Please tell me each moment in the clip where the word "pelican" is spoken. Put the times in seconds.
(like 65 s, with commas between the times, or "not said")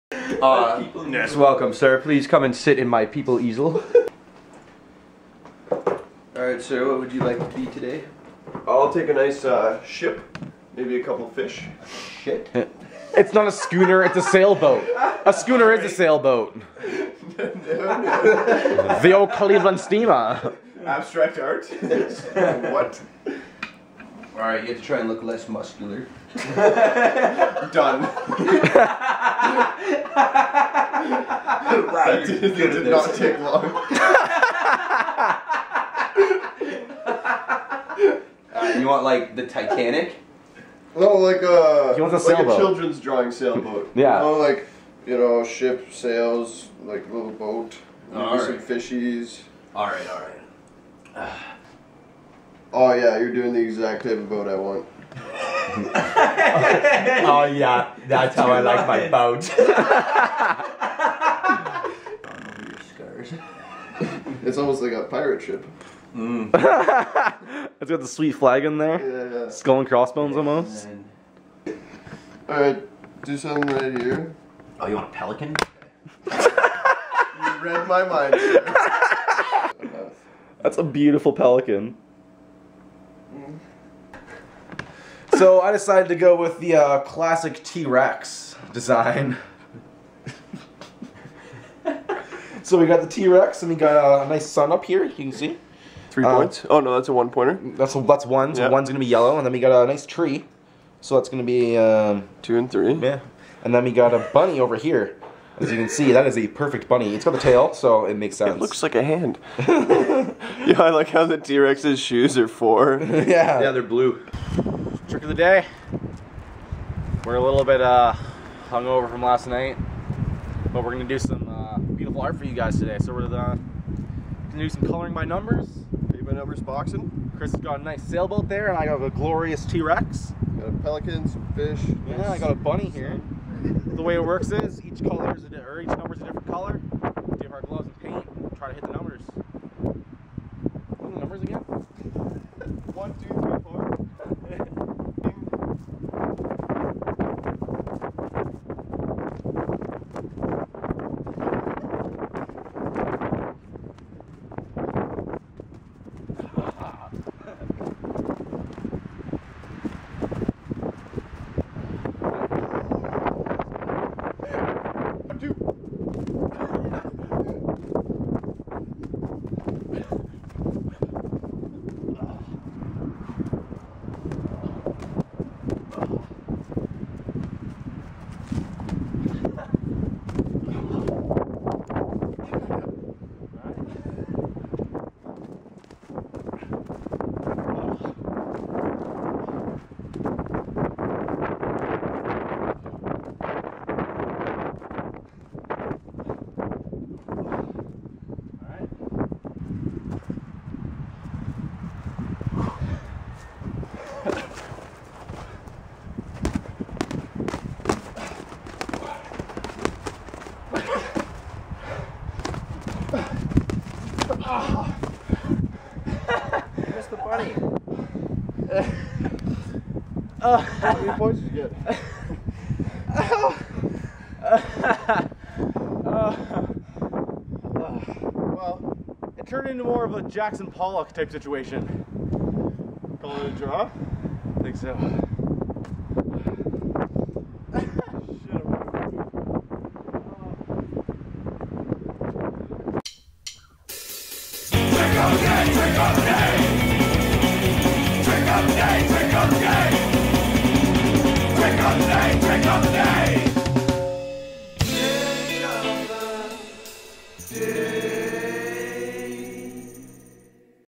75 s, 81 s, 130 s.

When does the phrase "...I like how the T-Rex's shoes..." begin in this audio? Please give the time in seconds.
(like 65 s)
110 s.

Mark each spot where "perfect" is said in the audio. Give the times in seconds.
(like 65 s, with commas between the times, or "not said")
106 s.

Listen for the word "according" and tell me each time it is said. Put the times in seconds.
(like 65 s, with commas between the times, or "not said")
not said.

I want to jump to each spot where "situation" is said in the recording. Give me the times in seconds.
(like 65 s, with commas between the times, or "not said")
231 s.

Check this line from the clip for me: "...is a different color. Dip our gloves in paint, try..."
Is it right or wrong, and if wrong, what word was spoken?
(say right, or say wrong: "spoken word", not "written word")
right.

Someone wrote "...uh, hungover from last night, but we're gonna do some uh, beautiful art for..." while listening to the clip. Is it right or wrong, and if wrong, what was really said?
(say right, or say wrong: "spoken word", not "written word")
right.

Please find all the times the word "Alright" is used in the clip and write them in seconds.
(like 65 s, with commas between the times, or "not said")
6 s, 72 s.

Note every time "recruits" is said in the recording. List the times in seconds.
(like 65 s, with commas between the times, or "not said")
not said.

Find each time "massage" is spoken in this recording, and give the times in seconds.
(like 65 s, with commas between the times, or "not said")
not said.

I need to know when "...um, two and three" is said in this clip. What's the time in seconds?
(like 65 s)
101 s.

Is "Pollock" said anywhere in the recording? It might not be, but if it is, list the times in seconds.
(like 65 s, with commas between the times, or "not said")
230 s.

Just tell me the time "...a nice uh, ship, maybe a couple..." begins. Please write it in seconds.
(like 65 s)
9 s.